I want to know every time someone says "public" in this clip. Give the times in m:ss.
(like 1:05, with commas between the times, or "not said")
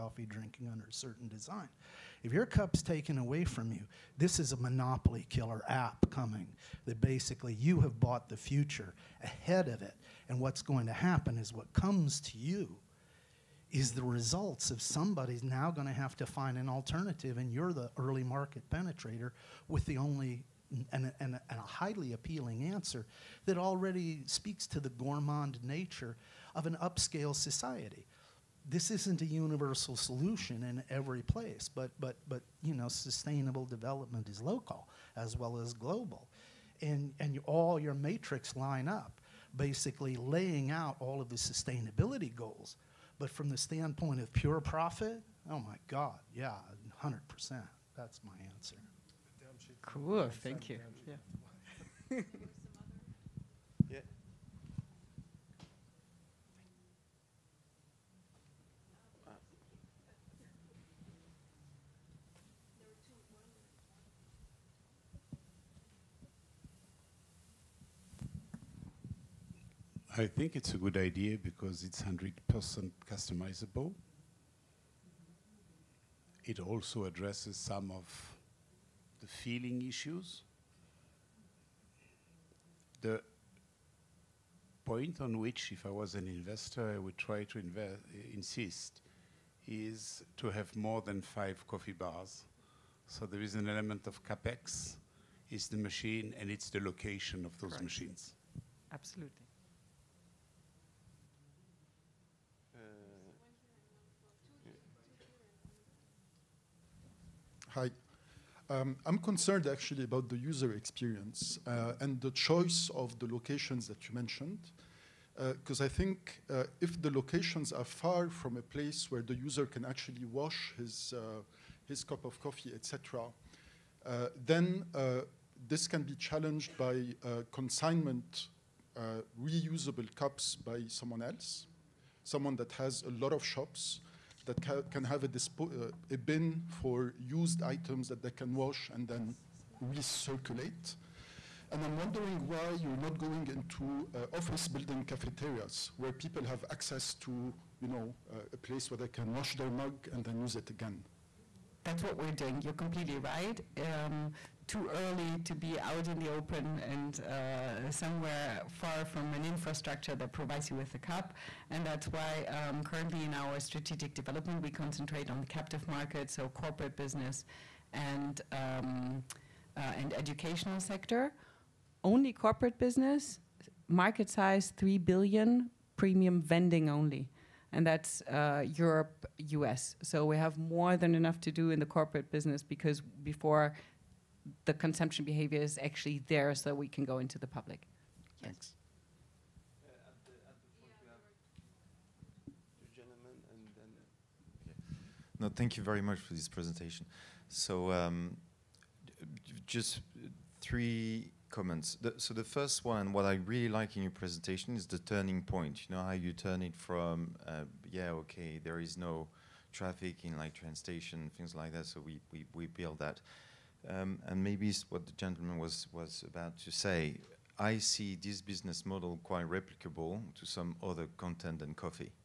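3:07.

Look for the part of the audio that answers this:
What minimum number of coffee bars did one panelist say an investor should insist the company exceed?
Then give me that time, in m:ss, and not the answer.
1:31.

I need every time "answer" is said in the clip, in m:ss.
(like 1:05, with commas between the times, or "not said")
0:22, 0:48.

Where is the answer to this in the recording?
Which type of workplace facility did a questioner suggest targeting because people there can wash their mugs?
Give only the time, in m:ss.
2:24.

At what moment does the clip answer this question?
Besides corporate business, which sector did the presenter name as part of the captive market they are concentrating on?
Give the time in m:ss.
2:50.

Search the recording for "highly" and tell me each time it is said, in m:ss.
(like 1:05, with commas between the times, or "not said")
0:21.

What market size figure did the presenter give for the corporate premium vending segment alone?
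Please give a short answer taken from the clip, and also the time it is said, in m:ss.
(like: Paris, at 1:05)
3 billion, at 2:54.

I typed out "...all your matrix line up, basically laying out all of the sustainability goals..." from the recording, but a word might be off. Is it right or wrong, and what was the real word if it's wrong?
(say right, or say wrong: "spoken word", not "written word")
right.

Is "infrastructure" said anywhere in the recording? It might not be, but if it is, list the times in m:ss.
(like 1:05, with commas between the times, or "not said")
2:39.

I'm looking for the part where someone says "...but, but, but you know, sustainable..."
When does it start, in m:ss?
0:31.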